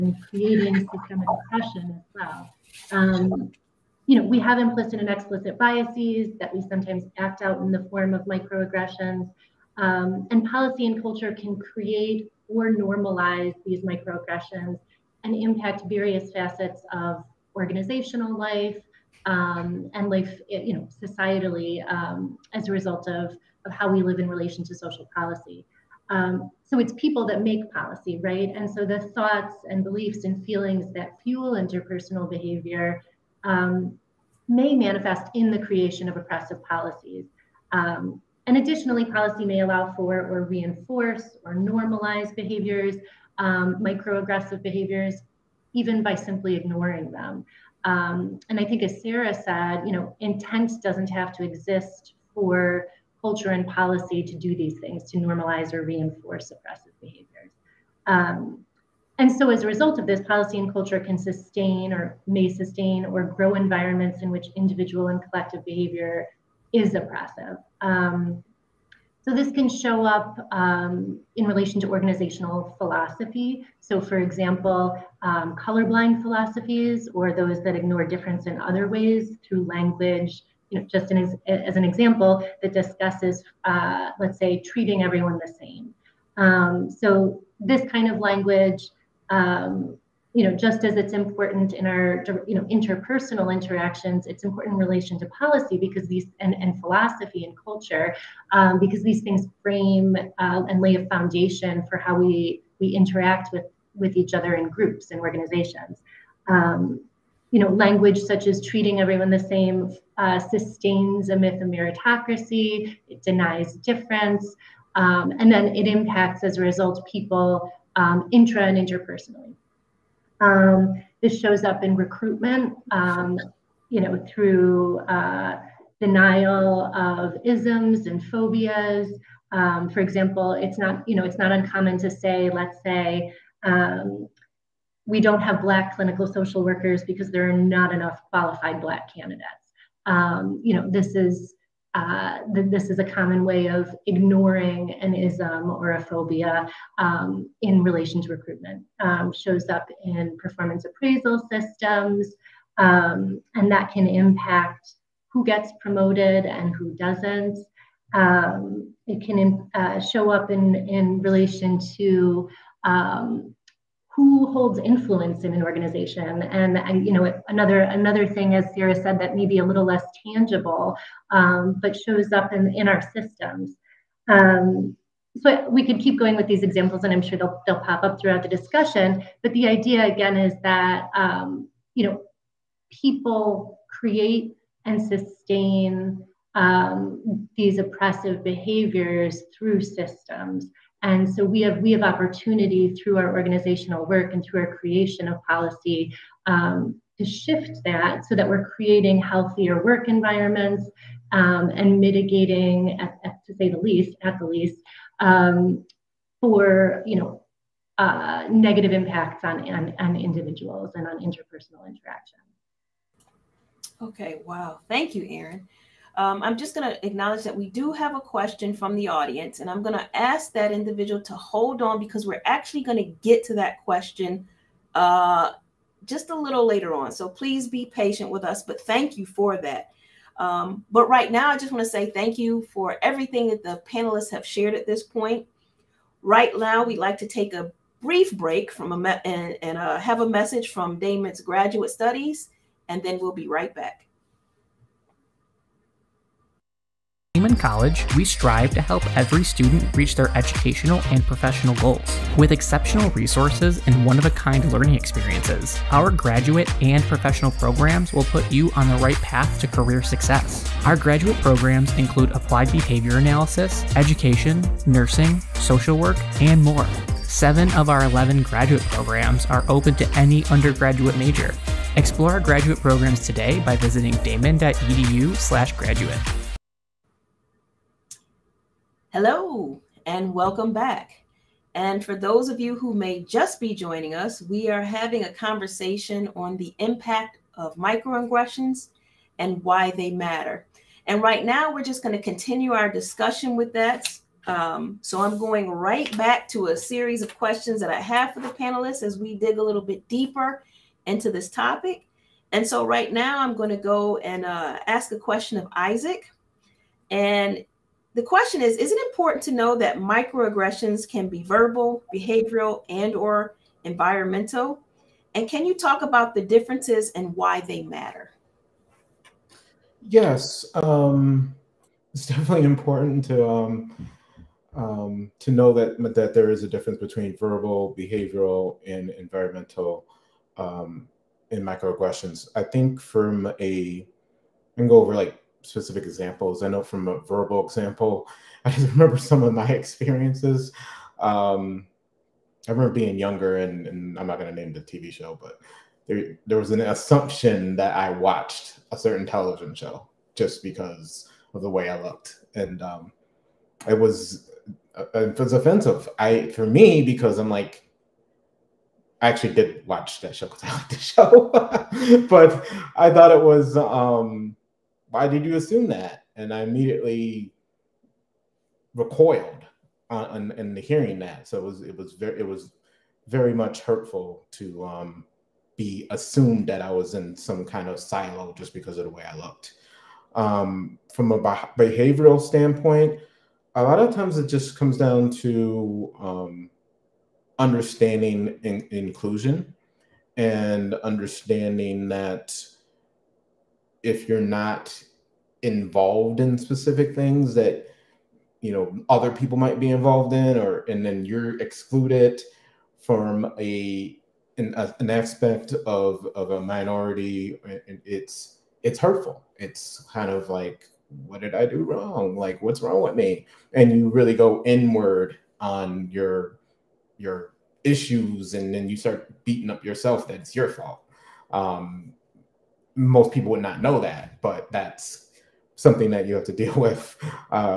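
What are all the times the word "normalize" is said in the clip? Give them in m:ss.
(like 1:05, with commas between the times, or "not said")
0:12, 0:41, 0:55.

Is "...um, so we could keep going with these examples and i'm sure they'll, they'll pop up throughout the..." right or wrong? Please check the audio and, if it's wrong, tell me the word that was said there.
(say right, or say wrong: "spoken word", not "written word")
right.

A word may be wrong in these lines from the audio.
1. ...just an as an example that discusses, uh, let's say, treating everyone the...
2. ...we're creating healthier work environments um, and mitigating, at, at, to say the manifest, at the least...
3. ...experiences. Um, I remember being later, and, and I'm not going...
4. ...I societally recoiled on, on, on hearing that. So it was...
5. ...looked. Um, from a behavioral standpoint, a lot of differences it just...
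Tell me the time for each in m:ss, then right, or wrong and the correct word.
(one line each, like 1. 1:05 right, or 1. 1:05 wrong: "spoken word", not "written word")
1. 1:20 right
2. 3:18 wrong: "least", not "manifest"
3. 5:39 wrong: "younger", not "later"
4. 6:06 wrong: "immediately", not "societally"
5. 6:19 wrong: "times", not "differences".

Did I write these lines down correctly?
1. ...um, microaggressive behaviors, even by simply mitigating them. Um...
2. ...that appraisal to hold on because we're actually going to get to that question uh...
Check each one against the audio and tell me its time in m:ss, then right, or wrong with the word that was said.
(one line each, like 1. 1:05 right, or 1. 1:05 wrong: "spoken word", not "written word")
1. 0:43 wrong: "ignoring", not "mitigating"
2. 3:40 wrong: "individual", not "appraisal".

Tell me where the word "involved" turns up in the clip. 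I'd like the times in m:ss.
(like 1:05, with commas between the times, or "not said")
6:35, 6:39.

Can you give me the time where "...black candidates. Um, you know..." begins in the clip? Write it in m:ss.
2:18.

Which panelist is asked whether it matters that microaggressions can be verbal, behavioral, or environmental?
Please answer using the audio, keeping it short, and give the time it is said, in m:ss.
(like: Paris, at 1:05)
Isaac, at 5:05.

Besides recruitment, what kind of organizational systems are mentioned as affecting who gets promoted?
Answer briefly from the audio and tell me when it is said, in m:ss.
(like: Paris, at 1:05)
performance appraisal systems, at 2:30.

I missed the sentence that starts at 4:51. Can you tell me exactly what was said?
And right now, we're just going to continue our discussion with that.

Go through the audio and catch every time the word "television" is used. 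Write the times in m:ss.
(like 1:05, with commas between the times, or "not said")
5:49.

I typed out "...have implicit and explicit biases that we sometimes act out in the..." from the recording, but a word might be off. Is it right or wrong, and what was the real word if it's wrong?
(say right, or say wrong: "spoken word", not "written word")
right.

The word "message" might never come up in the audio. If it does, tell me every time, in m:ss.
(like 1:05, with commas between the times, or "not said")
4:00.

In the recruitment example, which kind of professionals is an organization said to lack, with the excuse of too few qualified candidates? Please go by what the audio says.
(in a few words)
black clinical social workers.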